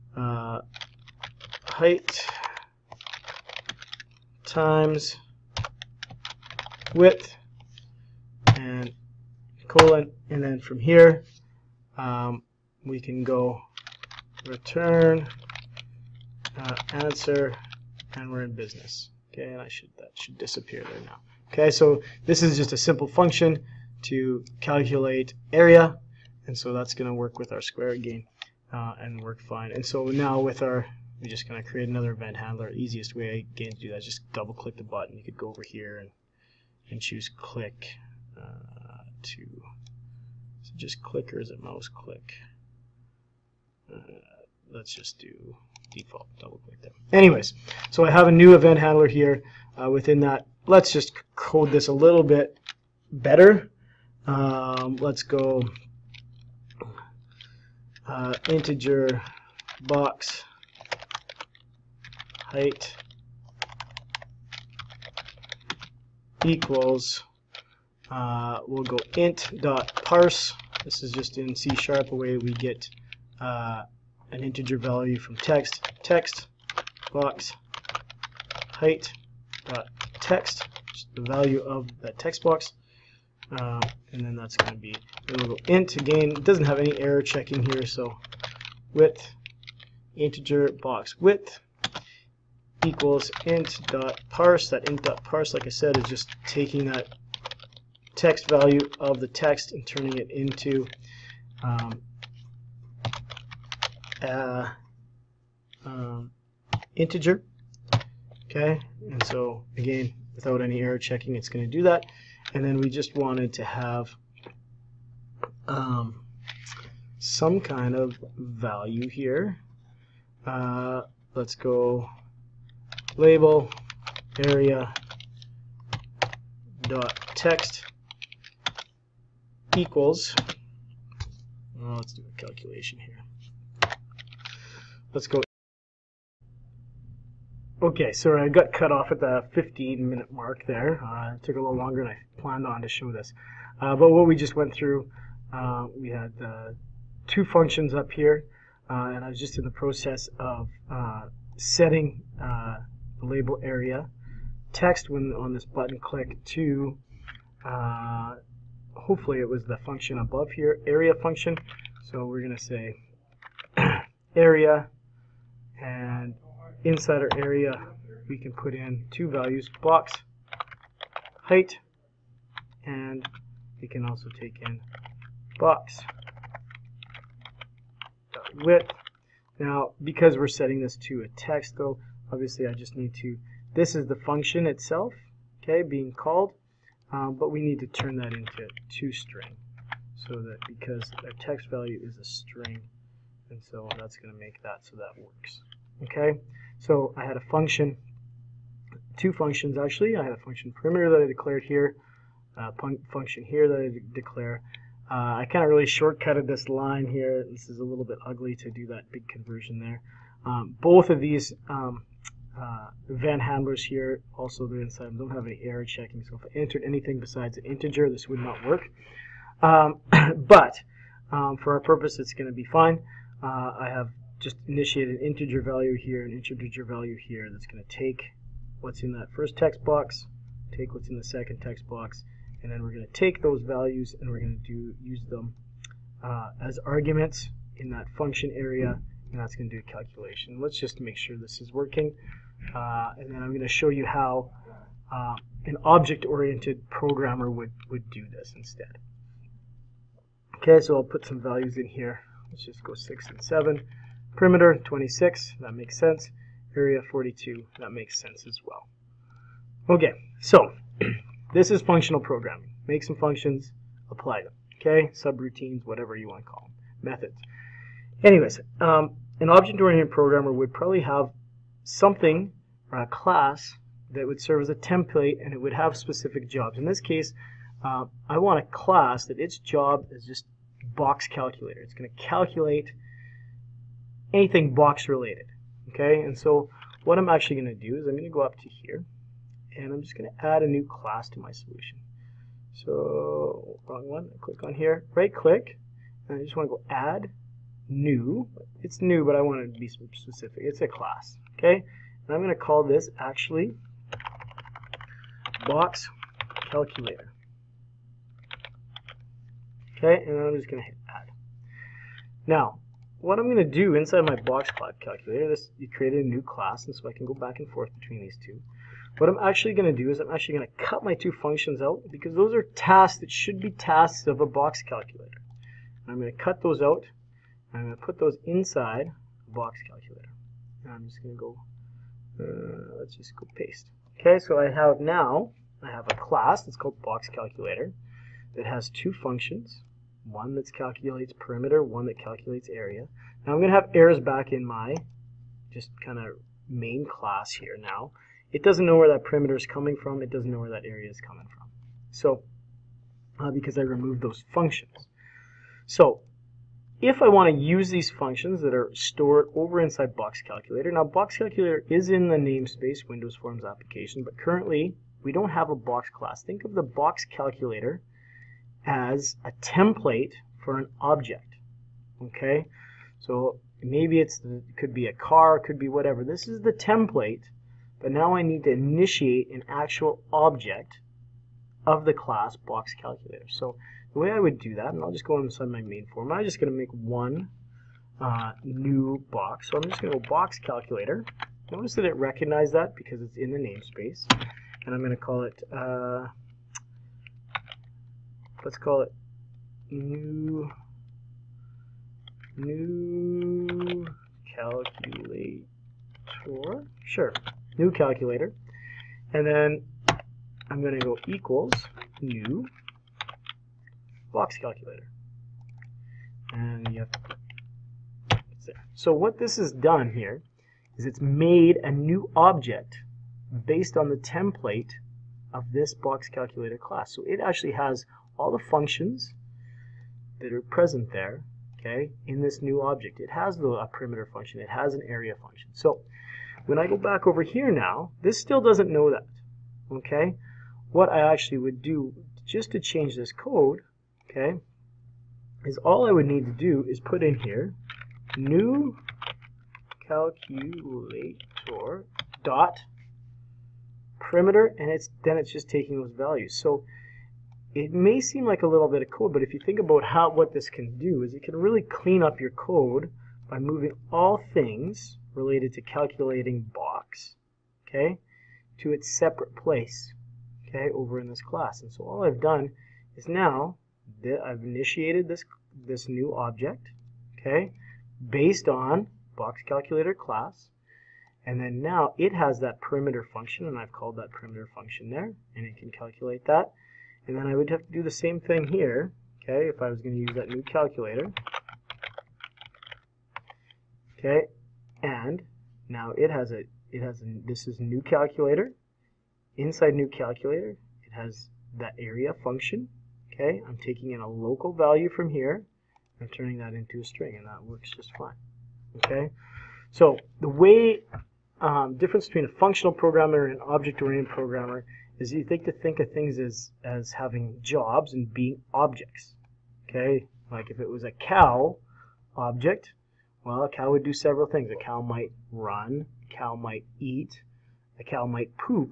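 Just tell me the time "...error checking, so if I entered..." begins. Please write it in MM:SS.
03:35.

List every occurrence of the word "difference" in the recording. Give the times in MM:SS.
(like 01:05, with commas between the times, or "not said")
08:31.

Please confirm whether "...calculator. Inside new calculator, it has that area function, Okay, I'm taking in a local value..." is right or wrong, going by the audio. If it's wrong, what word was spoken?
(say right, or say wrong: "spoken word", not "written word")
right.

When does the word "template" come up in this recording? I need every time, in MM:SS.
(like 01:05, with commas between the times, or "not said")
04:34, 06:09, 06:16, 07:04.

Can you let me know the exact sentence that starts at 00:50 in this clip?
Let's just code this a little bit better.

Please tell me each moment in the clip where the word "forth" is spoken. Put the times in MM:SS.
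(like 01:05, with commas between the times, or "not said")
05:17.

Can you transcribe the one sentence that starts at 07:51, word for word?
And so all I've done is now I've initiated this, this new object, okay, based on box calculator class.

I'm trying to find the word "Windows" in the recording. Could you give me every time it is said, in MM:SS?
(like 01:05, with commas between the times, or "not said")
06:03.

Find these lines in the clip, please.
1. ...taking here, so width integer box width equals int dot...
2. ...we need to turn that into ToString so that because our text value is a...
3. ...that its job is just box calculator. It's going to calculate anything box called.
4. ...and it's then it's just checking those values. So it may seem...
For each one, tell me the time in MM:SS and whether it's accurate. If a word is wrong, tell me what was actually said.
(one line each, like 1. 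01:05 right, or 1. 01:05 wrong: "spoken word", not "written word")
1. 01:27 wrong: "checking", not "taking"
2. 03:07 right
3. 04:39 wrong: "related", not "called"
4. 07:34 wrong: "taking", not "checking".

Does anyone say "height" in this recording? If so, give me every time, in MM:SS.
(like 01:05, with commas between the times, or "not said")
00:01, 01:02, 01:18, 02:51.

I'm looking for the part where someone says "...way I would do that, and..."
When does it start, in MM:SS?
06:24.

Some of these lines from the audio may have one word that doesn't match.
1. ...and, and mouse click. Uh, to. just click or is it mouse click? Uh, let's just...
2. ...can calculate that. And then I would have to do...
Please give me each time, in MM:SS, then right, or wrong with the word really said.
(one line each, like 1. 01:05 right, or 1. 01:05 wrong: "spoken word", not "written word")
1. 00:35 wrong: "choose", not "mouse"
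2. 08:05 right.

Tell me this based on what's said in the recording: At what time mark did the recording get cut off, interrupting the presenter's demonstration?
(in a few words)
15 minute mark.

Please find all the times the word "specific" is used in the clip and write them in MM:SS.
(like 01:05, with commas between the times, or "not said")
04:35, 04:59.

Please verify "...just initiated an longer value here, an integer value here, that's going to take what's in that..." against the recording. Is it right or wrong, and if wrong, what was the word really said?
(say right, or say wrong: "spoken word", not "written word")
wrong: "integer", not "longer".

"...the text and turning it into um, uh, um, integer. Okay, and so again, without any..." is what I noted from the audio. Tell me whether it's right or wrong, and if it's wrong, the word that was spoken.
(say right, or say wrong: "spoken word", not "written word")
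right.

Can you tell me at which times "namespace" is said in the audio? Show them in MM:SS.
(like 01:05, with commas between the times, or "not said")
06:02, 06:33.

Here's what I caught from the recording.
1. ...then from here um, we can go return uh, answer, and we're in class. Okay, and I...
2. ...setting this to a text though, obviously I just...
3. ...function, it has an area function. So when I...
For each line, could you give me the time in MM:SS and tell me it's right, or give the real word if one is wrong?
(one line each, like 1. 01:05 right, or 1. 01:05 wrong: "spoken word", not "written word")
1. 00:10 wrong: "business", not "class"
2. 03:00 right
3. 07:14 right.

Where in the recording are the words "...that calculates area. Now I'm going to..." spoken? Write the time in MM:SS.
05:42.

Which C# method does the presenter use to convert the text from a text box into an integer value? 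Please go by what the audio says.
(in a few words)
int.parse.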